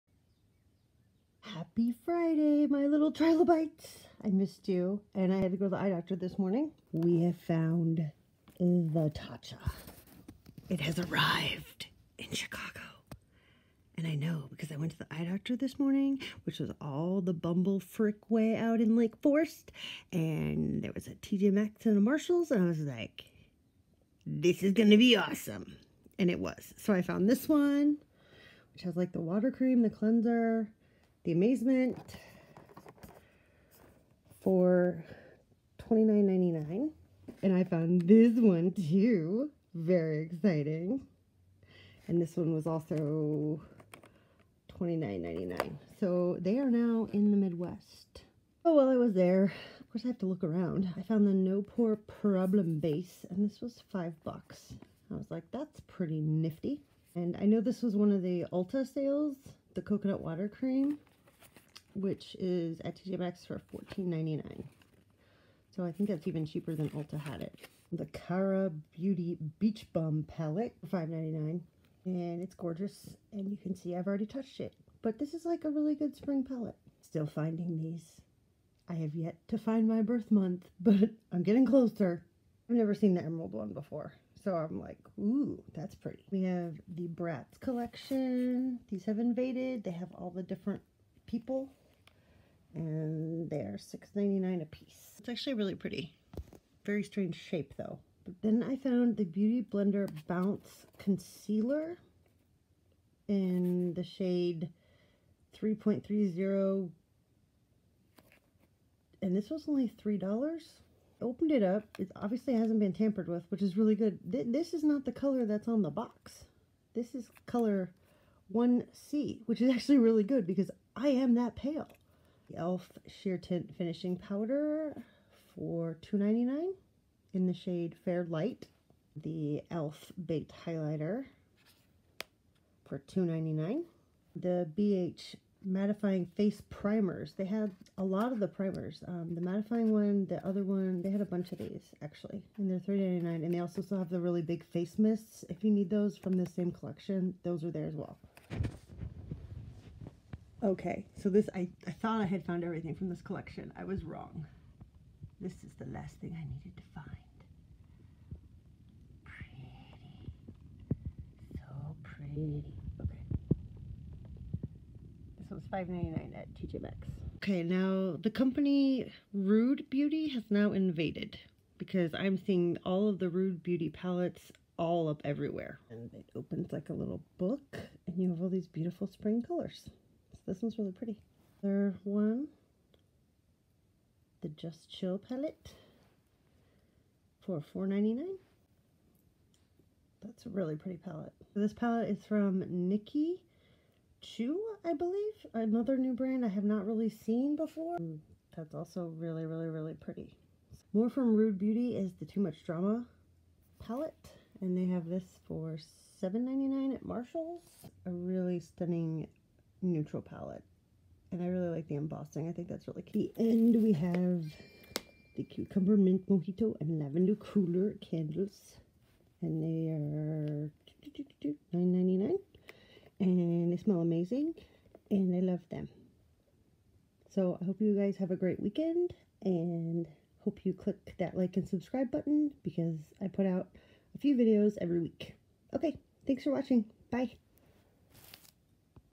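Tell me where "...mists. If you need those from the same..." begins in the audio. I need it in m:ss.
2:24.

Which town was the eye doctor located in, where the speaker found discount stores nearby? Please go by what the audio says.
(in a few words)
Lake Forest.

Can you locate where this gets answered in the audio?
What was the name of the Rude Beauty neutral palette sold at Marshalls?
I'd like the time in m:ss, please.
3:22.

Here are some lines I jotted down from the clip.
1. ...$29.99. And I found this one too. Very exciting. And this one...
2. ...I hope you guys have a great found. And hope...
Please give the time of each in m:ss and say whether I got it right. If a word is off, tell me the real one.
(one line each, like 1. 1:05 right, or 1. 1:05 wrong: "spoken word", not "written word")
1. 0:35 right
2. 3:47 wrong: "weekend", not "found".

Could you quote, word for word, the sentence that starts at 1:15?
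But this is like a really good spring palette.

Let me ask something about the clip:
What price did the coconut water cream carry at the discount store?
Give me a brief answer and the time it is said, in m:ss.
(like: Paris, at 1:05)
$14.99, at 1:03.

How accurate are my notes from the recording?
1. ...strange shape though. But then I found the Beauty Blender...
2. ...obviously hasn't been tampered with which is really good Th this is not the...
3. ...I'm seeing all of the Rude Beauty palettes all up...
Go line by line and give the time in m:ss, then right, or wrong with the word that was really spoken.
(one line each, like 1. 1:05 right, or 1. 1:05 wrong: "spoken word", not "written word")
1. 1:37 right
2. 1:52 right
3. 2:52 right.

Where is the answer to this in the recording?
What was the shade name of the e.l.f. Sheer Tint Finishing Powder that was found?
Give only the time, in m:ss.
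2:08.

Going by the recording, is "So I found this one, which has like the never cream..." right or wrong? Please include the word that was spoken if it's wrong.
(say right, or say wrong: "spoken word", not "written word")
wrong: "water", not "never".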